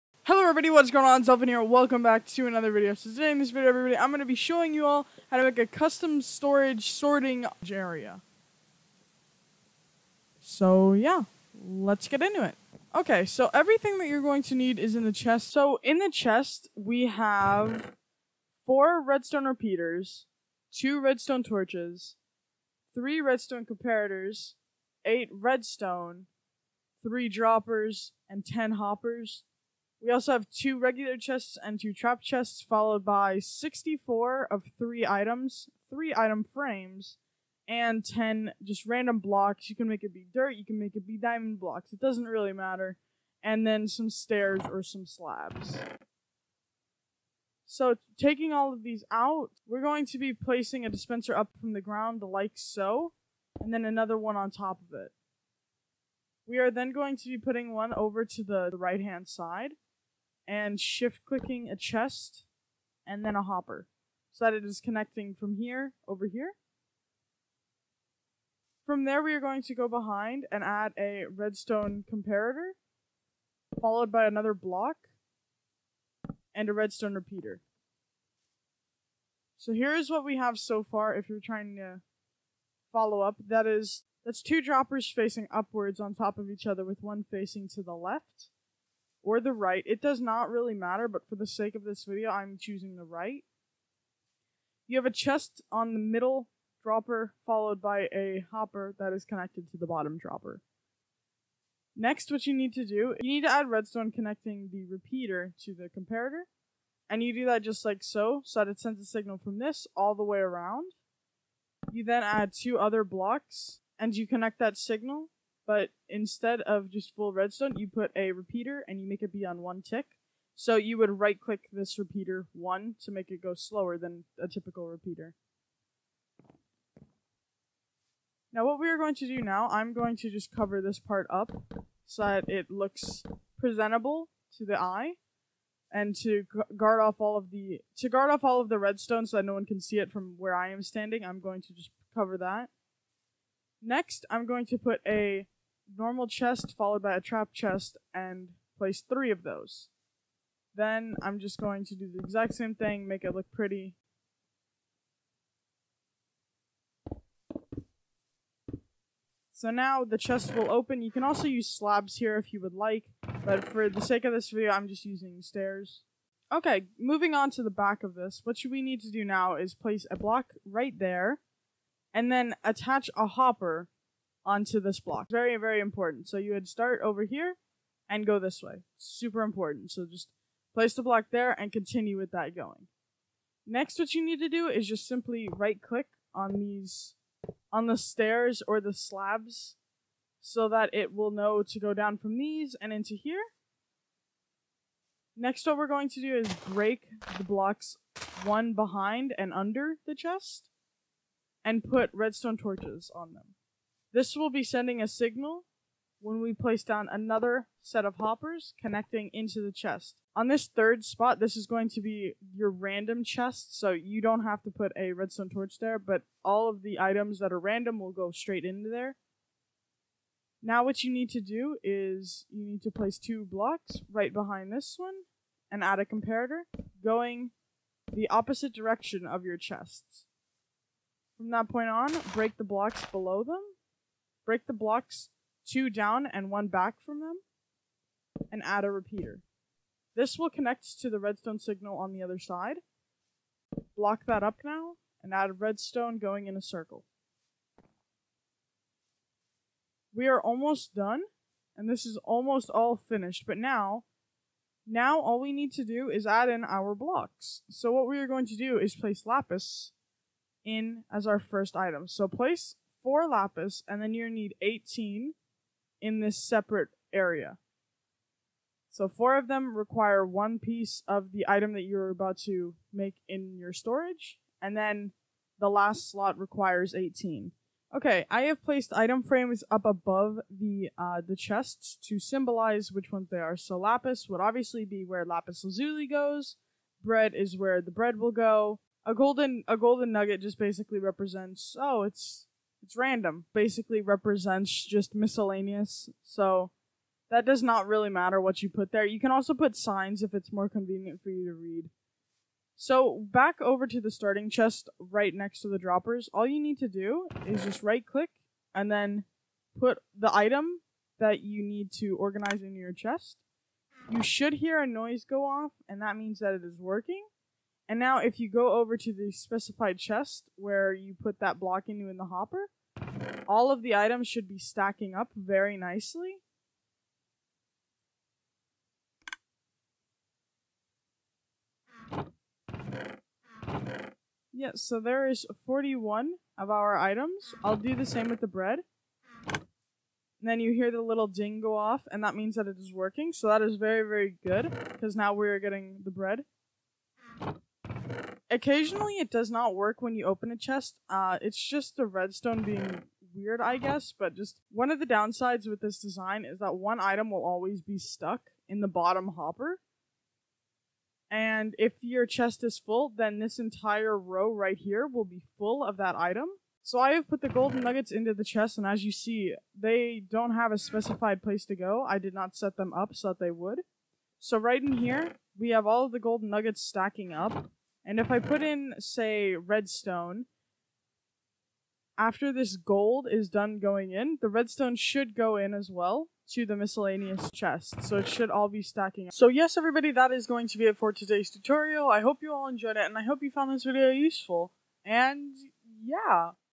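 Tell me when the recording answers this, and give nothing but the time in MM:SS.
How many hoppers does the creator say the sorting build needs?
00:28.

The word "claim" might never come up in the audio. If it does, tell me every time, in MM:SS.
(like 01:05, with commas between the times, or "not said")
not said.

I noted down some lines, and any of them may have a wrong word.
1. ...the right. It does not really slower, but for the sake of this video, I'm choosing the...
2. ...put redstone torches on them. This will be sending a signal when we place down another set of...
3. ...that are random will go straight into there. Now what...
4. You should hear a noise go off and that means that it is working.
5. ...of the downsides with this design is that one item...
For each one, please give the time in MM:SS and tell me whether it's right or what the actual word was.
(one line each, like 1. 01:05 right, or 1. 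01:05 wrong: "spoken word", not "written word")
1. 01:29 wrong: "matter", not "slower"
2. 03:21 right
3. 03:37 right
4. 05:14 right
5. 05:54 right.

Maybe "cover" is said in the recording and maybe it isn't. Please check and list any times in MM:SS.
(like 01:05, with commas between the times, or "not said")
02:10, 02:22.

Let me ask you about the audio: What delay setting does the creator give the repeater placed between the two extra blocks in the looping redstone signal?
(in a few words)
1 tick.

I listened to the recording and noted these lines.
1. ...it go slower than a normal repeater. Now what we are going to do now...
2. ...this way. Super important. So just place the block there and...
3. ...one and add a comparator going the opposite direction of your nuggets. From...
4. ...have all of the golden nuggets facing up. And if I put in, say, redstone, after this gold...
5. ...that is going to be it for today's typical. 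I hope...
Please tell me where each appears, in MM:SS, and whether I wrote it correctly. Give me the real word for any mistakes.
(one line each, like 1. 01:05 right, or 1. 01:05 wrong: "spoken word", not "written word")
1. 02:03 wrong: "typical", not "normal"
2. 02:58 right
3. 03:44 wrong: "chests", not "nuggets"
4. 06:15 wrong: "stacking", not "facing"
5. 06:30 wrong: "tutorial", not "typical".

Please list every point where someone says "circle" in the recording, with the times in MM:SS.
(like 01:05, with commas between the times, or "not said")
04:06.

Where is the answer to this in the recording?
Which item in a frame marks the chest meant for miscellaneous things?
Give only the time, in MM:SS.
04:49.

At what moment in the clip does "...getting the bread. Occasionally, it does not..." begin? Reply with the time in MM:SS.
05:45.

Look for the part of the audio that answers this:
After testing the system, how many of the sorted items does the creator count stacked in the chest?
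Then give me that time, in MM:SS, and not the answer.
05:35.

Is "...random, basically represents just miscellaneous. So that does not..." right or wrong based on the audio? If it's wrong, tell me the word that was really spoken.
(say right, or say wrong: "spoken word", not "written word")
right.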